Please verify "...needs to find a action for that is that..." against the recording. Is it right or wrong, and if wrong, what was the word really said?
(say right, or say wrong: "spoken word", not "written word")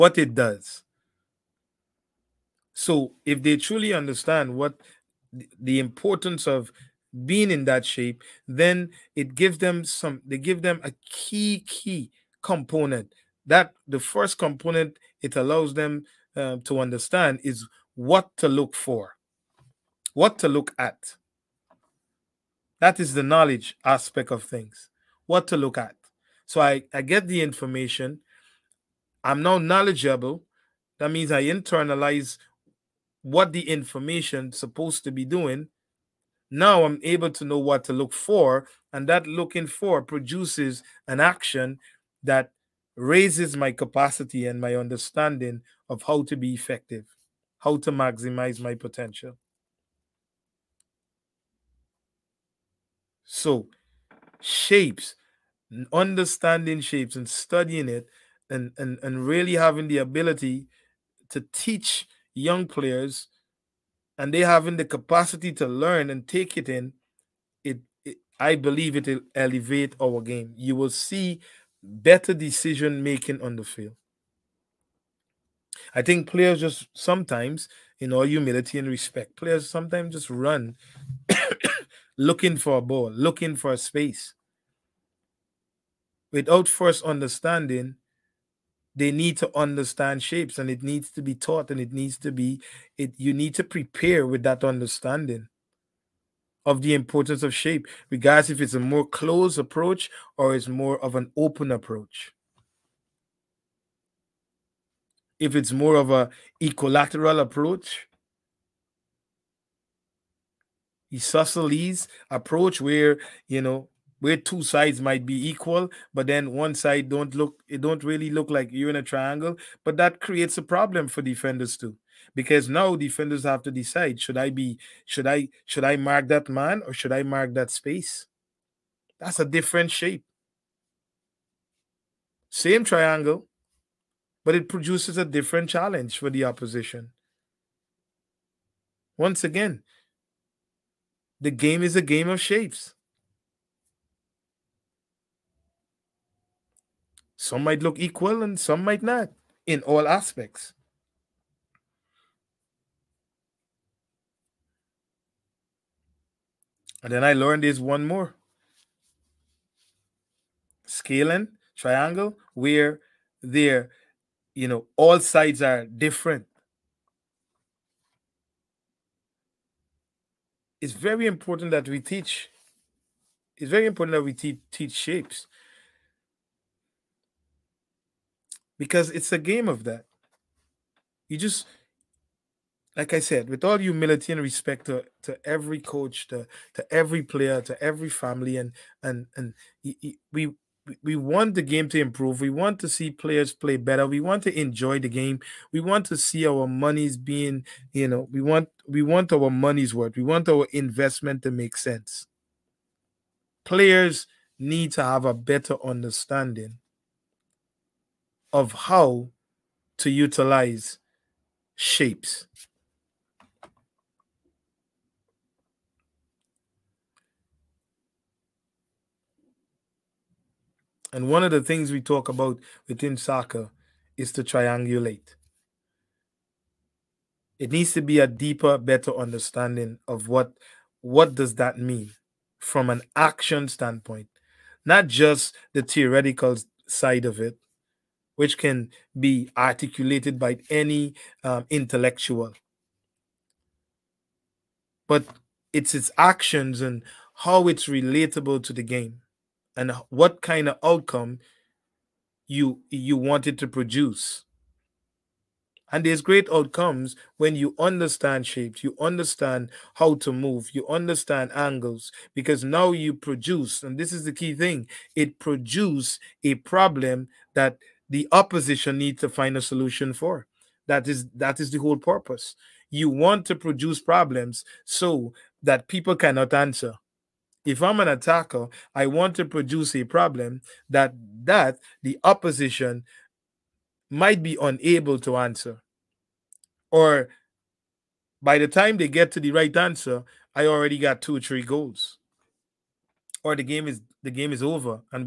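wrong: "solution", not "action".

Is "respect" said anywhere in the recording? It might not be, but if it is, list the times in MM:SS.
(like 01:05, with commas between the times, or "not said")
01:18, 03:04.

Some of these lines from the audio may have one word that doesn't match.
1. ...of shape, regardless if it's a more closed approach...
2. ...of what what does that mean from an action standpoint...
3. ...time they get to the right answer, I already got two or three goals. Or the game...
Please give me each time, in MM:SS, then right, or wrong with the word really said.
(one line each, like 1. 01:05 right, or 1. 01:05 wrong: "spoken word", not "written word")
1. 01:37 right
2. 03:50 right
3. 04:48 right.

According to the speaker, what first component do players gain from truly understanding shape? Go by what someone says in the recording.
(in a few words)
Knowledge.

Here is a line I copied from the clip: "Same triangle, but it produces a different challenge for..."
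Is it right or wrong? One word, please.
right.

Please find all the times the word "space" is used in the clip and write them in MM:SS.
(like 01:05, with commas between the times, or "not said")
01:23, 02:07.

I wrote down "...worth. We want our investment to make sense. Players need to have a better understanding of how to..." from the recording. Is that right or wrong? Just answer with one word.
right.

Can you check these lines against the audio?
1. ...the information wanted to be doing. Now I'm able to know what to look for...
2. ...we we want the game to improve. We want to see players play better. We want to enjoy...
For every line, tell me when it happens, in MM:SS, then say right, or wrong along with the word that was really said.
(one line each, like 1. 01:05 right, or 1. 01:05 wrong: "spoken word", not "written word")
1. 00:33 wrong: "supposed", not "wanted"
2. 03:10 right.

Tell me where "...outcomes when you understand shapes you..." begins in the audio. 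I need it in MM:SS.
04:16.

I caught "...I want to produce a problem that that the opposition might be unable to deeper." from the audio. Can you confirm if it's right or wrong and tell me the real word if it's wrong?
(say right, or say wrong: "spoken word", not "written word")
wrong: "answer", not "deeper".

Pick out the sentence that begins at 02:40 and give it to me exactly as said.
Scalene, triangle, where there, you know, all sides are different.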